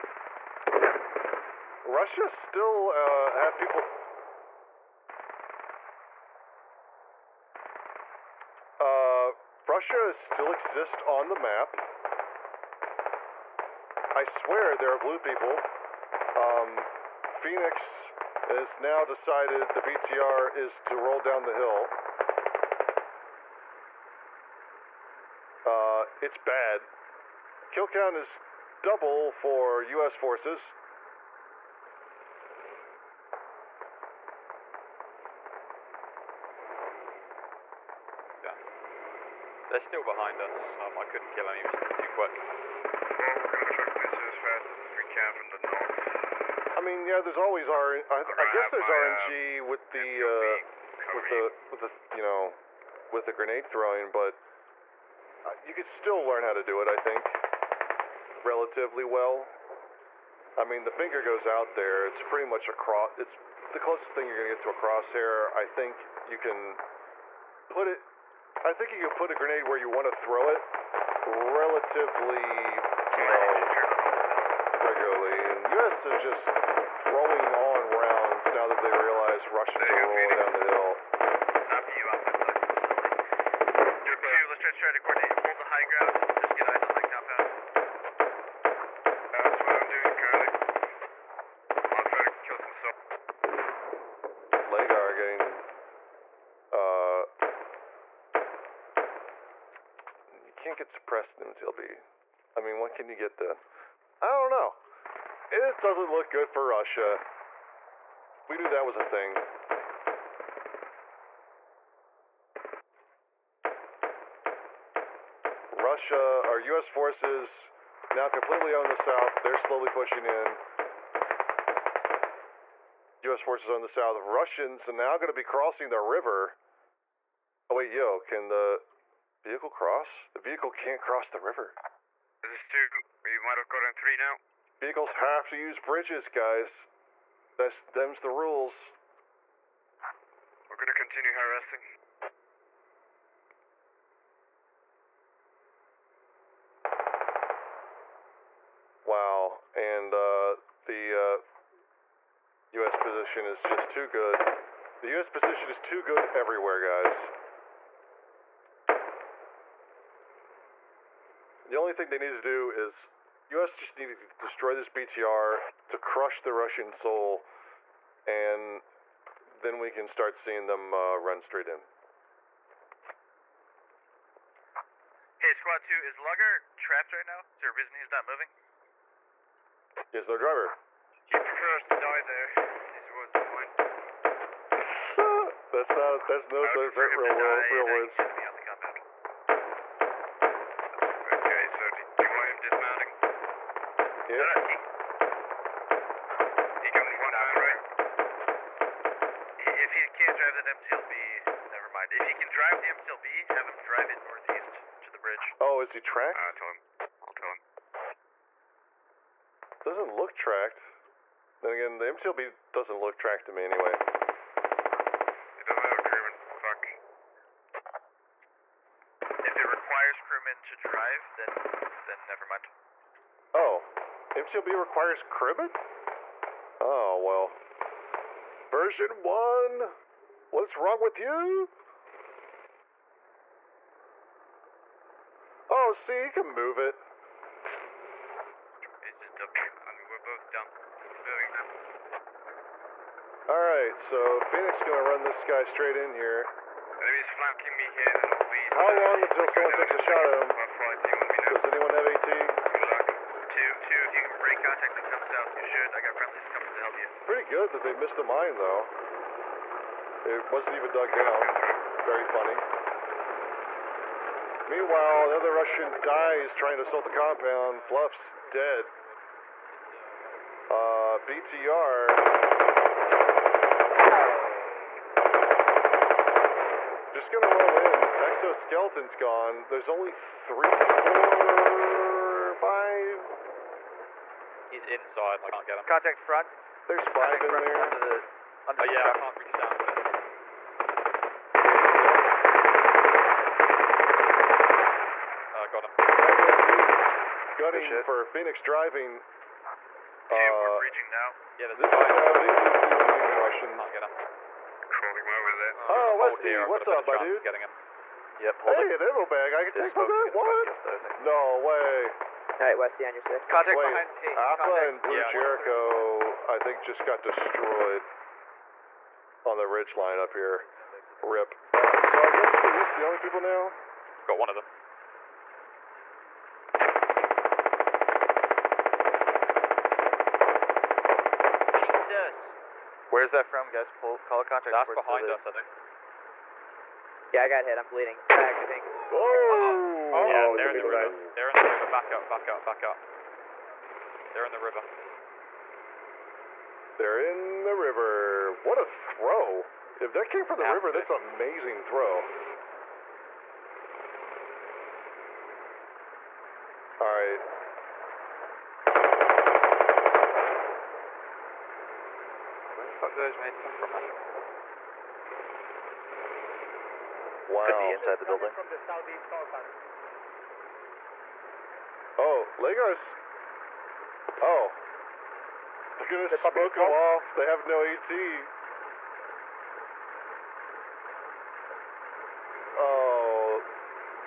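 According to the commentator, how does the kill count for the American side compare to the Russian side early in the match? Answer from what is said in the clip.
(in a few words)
Double.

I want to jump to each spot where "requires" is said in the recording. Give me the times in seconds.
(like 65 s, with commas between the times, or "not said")
219 s, 224 s.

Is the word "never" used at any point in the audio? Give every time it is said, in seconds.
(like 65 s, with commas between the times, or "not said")
201 s, 222 s.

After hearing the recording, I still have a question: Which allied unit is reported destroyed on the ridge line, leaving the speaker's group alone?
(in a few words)
Jericho.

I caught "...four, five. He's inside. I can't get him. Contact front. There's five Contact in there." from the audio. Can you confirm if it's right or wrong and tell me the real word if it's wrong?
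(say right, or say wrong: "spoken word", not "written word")
right.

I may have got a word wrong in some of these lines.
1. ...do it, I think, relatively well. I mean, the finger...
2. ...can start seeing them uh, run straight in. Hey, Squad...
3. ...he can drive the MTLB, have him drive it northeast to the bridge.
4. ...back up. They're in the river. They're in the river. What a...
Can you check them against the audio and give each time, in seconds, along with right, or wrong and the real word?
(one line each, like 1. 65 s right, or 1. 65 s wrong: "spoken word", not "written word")
1. 56 s right
2. 169 s right
3. 202 s right
4. 342 s right.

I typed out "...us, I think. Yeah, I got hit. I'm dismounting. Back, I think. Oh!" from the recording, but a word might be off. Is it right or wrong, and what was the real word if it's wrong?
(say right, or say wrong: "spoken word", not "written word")
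wrong: "bleeding", not "dismounting".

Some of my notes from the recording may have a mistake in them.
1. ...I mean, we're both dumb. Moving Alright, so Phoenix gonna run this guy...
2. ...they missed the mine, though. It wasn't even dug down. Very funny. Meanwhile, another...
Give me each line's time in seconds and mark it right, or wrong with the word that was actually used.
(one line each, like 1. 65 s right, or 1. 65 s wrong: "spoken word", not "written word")
1. 239 s right
2. 257 s right.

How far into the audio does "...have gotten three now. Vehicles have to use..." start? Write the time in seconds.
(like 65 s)
133 s.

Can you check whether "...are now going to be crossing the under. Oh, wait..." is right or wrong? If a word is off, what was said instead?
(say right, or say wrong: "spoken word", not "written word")
wrong: "river", not "under".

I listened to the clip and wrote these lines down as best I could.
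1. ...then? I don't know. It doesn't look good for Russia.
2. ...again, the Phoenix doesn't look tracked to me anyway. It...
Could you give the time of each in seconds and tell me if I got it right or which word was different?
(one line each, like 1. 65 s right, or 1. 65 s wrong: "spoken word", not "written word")
1. 103 s right
2. 211 s wrong: "MTLB", not "Phoenix".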